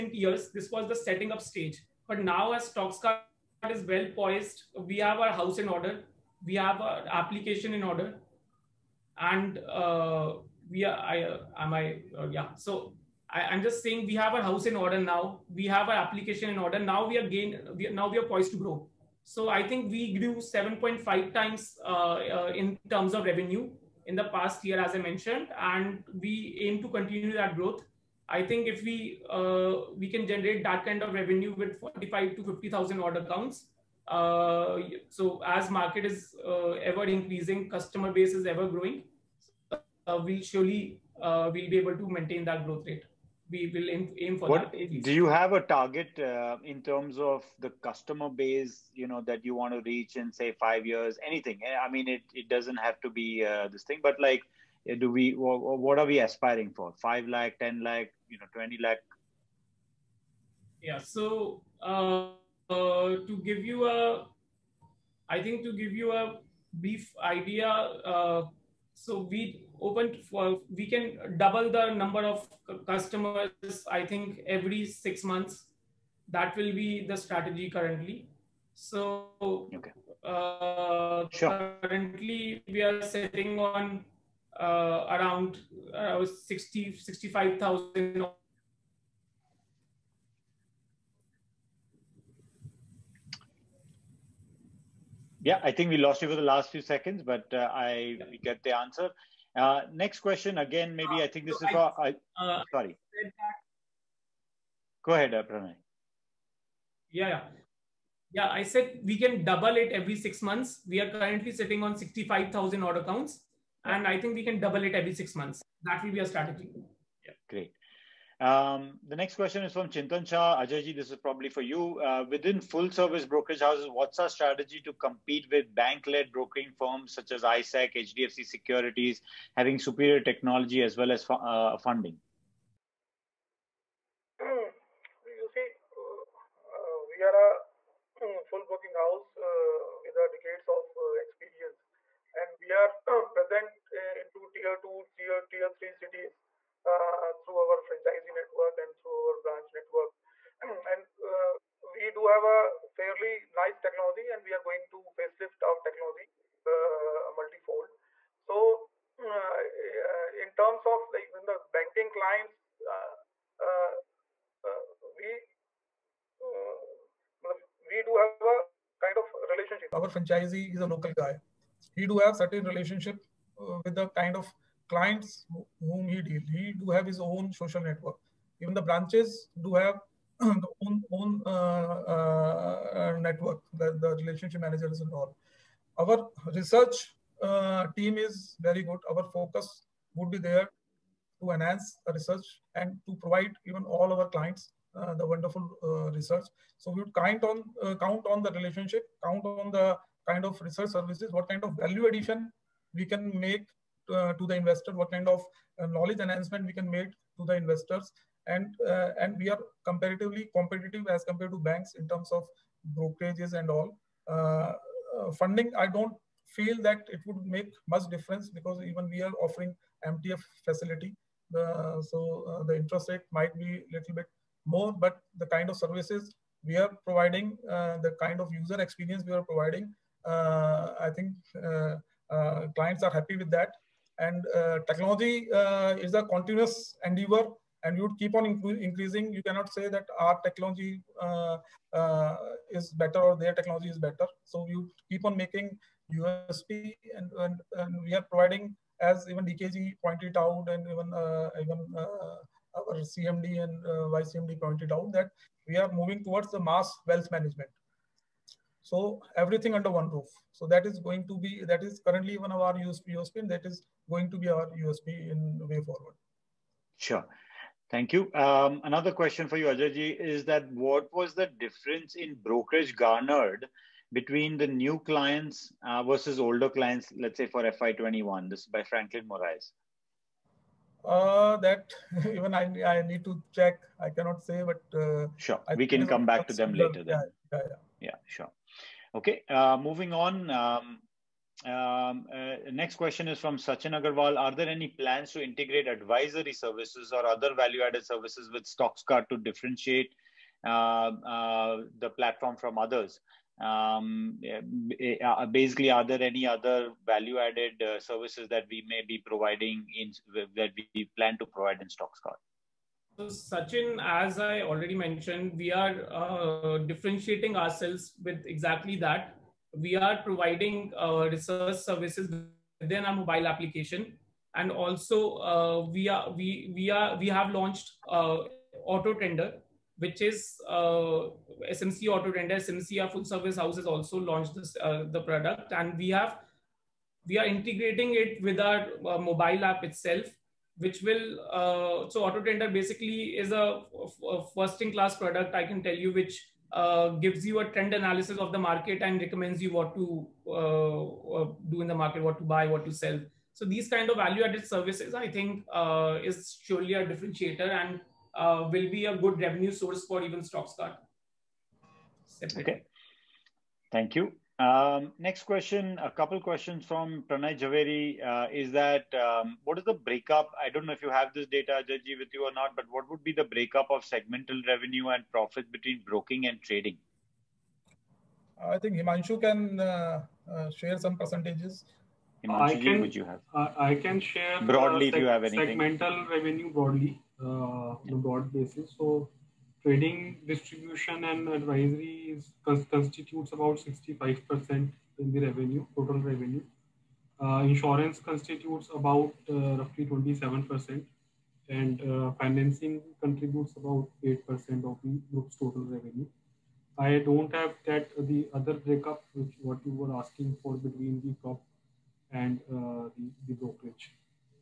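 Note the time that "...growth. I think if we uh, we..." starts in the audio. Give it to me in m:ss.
0:27.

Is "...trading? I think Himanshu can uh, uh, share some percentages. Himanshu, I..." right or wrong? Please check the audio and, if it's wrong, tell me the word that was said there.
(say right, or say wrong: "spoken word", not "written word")
right.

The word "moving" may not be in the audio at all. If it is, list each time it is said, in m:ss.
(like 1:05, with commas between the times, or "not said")
4:15, 4:49.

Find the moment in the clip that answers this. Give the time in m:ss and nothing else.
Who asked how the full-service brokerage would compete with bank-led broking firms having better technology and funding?
1:59.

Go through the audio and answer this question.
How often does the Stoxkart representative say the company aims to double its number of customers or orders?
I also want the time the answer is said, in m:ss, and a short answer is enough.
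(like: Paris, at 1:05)
Every 6 months, at 1:14.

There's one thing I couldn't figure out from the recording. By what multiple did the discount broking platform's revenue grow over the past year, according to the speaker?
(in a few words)
7.5 times.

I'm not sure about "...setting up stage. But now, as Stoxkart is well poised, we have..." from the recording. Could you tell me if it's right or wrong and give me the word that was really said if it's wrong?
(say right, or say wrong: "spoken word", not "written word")
right.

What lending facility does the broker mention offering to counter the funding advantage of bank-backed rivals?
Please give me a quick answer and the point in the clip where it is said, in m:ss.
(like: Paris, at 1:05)
MTF facility, at 3:40.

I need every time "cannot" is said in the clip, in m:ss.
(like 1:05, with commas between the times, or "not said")
3:59, 4:44.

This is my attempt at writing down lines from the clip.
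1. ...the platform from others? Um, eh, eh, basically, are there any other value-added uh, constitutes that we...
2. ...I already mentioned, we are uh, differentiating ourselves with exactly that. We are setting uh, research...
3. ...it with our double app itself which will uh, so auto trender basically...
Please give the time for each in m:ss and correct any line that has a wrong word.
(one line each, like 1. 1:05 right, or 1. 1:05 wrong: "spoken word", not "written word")
1. 5:01 wrong: "services", not "constitutes"
2. 5:14 wrong: "providing", not "setting"
3. 5:38 wrong: "mobile", not "double".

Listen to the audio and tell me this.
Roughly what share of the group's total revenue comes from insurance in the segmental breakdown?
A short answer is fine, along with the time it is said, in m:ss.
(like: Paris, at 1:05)
27%, at 6:40.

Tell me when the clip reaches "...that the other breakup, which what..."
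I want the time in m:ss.
6:47.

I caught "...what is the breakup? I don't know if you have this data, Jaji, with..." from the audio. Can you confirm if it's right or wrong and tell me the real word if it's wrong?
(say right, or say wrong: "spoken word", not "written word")
right.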